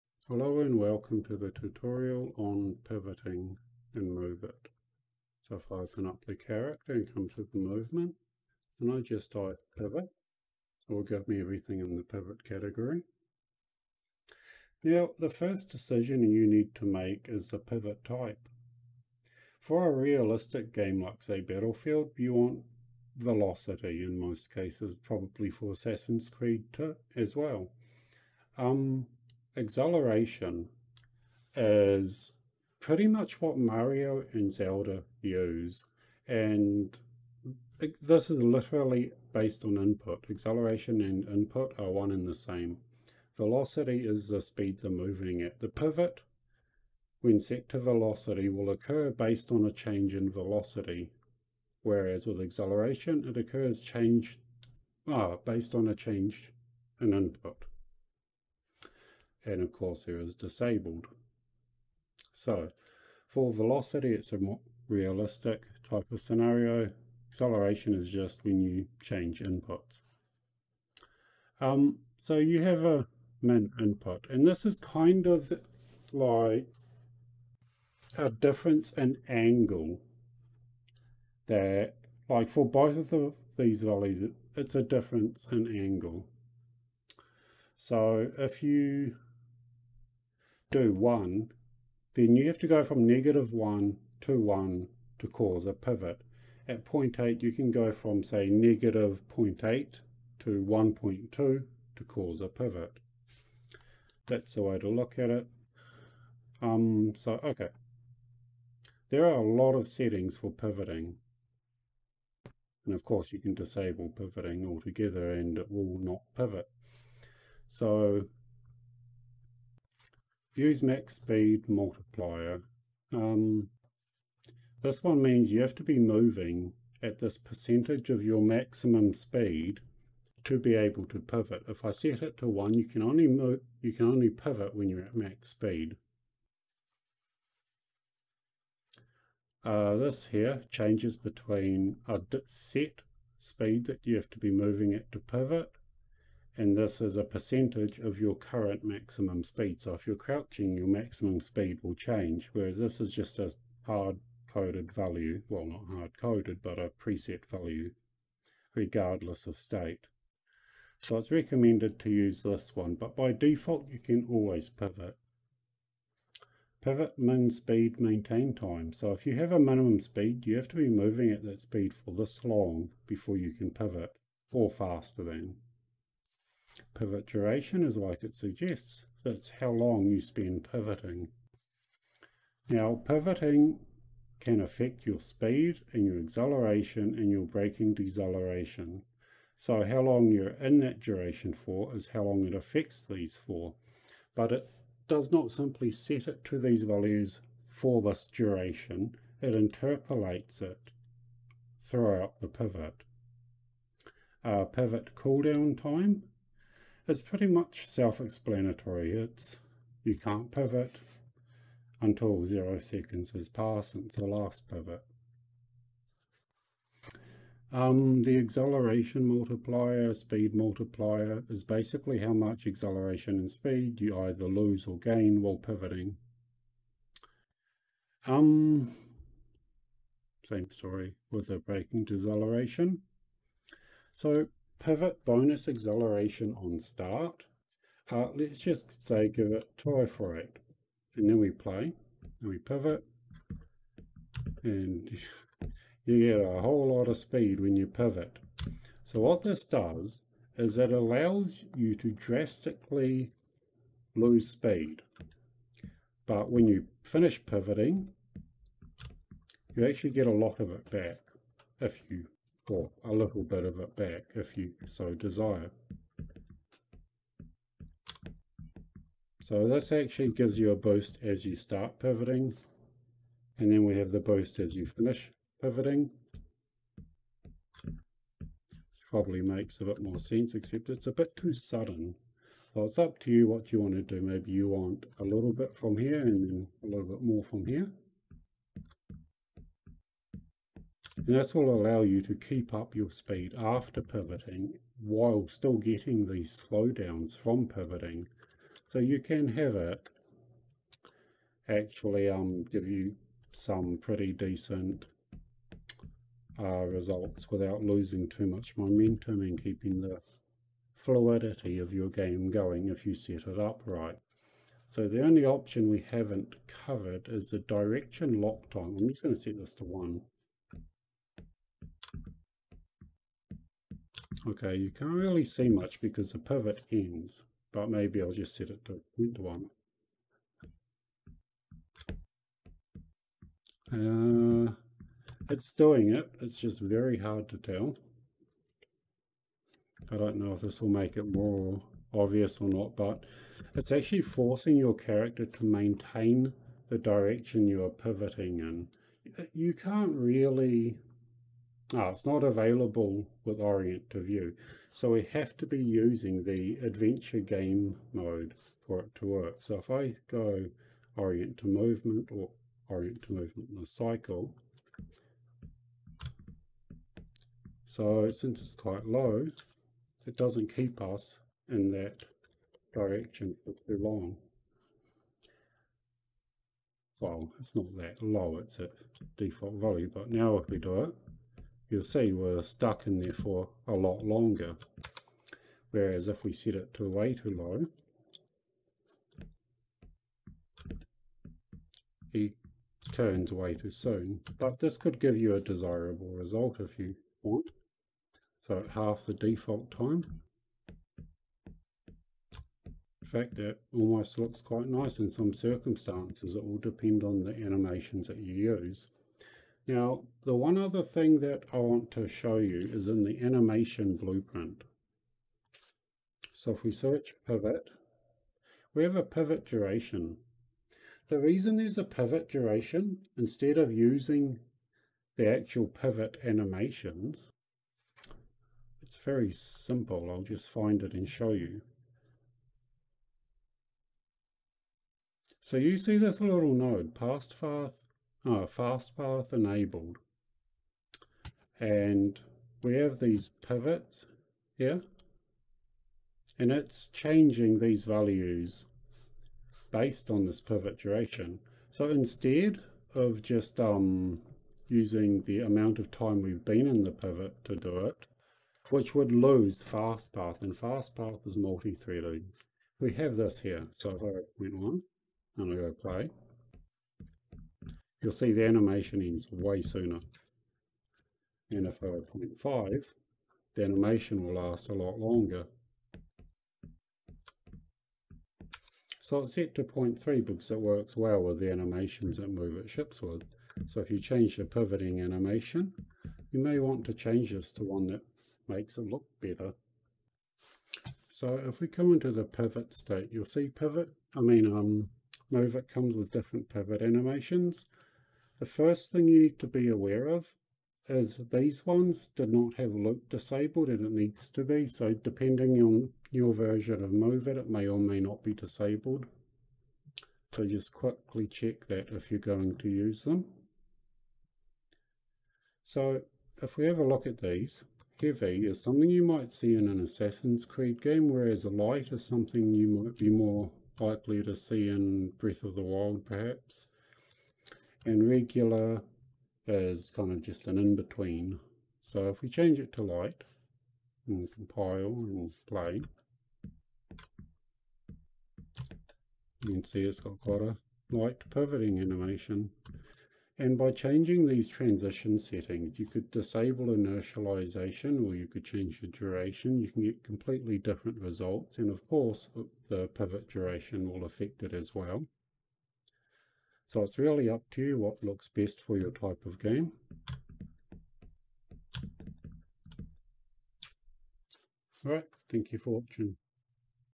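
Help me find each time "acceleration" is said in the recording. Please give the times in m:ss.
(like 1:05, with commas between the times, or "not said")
0:29, 0:40, 0:52, 1:07, 3:06, 3:38, 3:42, 3:55.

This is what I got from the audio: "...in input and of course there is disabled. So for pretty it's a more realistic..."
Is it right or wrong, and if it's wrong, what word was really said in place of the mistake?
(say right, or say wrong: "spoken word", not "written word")
wrong: "velocity", not "pretty".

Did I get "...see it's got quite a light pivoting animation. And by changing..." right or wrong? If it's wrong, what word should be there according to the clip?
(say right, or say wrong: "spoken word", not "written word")
right.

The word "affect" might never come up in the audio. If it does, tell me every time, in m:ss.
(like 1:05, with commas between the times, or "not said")
3:04, 3:12, 9:14.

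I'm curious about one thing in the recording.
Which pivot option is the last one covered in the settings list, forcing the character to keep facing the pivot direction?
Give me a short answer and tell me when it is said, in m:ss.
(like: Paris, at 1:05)
Direction lock time, at 5:17.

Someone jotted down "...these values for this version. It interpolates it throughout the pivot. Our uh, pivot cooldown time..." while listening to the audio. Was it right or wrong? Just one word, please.
wrong.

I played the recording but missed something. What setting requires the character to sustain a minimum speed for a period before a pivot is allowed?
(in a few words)
Pivot min speed maintain time.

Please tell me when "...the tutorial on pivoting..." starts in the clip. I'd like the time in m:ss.
0:01.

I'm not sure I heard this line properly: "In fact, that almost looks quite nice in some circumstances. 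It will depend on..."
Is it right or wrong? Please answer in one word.
right.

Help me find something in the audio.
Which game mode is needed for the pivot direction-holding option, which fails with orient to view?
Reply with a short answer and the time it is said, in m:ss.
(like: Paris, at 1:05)
Adventure game mode, at 5:56.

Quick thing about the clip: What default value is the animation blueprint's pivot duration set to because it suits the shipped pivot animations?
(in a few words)
0.3.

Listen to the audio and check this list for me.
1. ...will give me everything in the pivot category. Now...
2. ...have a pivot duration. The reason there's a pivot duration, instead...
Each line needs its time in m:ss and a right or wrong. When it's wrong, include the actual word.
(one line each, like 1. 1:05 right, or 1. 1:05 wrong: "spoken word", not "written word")
1. 0:10 right
2. 6:59 right.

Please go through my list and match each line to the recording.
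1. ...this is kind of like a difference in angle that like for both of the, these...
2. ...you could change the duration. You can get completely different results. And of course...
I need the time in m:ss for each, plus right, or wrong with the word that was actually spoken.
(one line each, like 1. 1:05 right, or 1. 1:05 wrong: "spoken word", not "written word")
1. 1:14 right
2. 9:08 right.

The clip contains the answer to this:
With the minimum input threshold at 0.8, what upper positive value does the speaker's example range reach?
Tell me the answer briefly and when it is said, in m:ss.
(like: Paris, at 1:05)
1.2, at 1:40.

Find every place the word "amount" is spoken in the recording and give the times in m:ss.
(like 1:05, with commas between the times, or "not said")
7:35.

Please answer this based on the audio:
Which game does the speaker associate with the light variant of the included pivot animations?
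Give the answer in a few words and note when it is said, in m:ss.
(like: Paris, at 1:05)
Breath of the Wild, at 8:45.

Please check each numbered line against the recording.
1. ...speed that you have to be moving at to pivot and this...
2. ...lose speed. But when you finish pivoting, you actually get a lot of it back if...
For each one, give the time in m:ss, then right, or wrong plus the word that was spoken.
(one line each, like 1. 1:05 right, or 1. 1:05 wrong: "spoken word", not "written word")
1. 2:23 right
2. 4:14 right.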